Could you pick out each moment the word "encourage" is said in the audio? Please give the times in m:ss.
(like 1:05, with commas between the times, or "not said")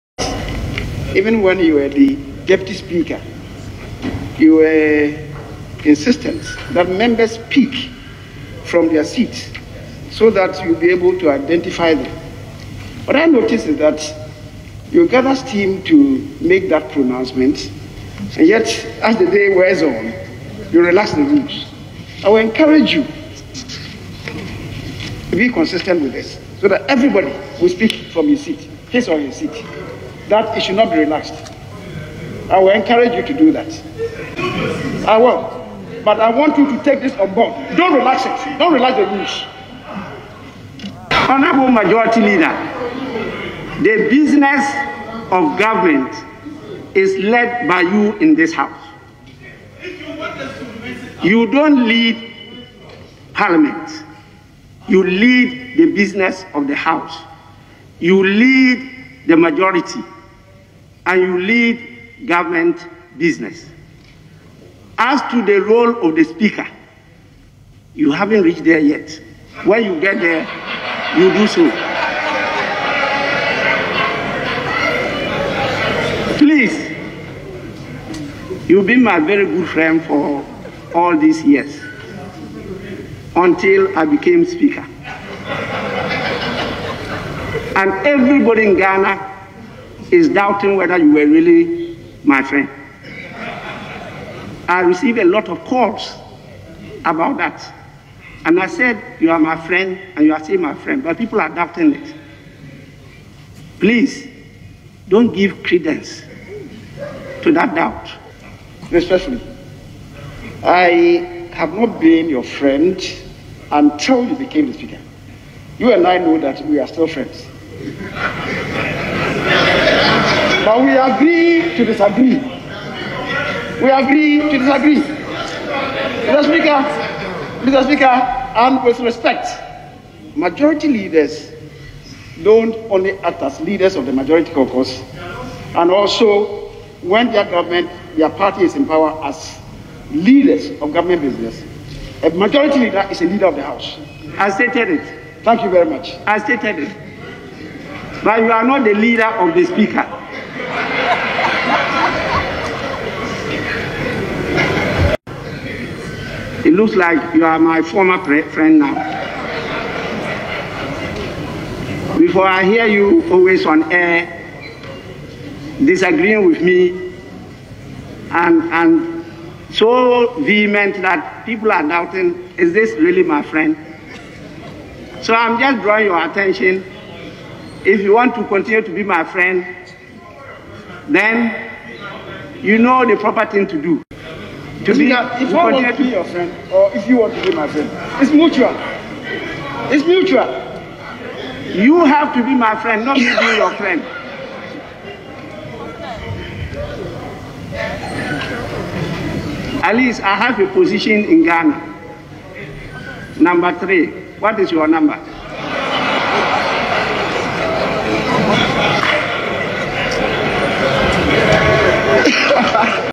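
0:22, 0:32.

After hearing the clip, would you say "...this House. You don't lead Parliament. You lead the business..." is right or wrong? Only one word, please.
right.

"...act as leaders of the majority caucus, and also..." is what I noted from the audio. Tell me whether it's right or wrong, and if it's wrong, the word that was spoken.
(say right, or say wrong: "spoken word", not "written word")
right.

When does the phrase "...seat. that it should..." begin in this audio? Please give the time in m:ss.
0:29.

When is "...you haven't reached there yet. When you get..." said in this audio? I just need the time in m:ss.
1:07.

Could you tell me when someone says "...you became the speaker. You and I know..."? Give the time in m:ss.
1:54.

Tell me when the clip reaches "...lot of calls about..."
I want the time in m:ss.
1:35.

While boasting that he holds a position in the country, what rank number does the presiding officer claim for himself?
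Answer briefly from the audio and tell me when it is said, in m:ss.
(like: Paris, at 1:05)
3, at 3:23.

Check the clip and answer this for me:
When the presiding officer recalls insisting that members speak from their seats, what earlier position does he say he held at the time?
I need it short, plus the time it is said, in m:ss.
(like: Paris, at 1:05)
Deputy speaker, at 0:02.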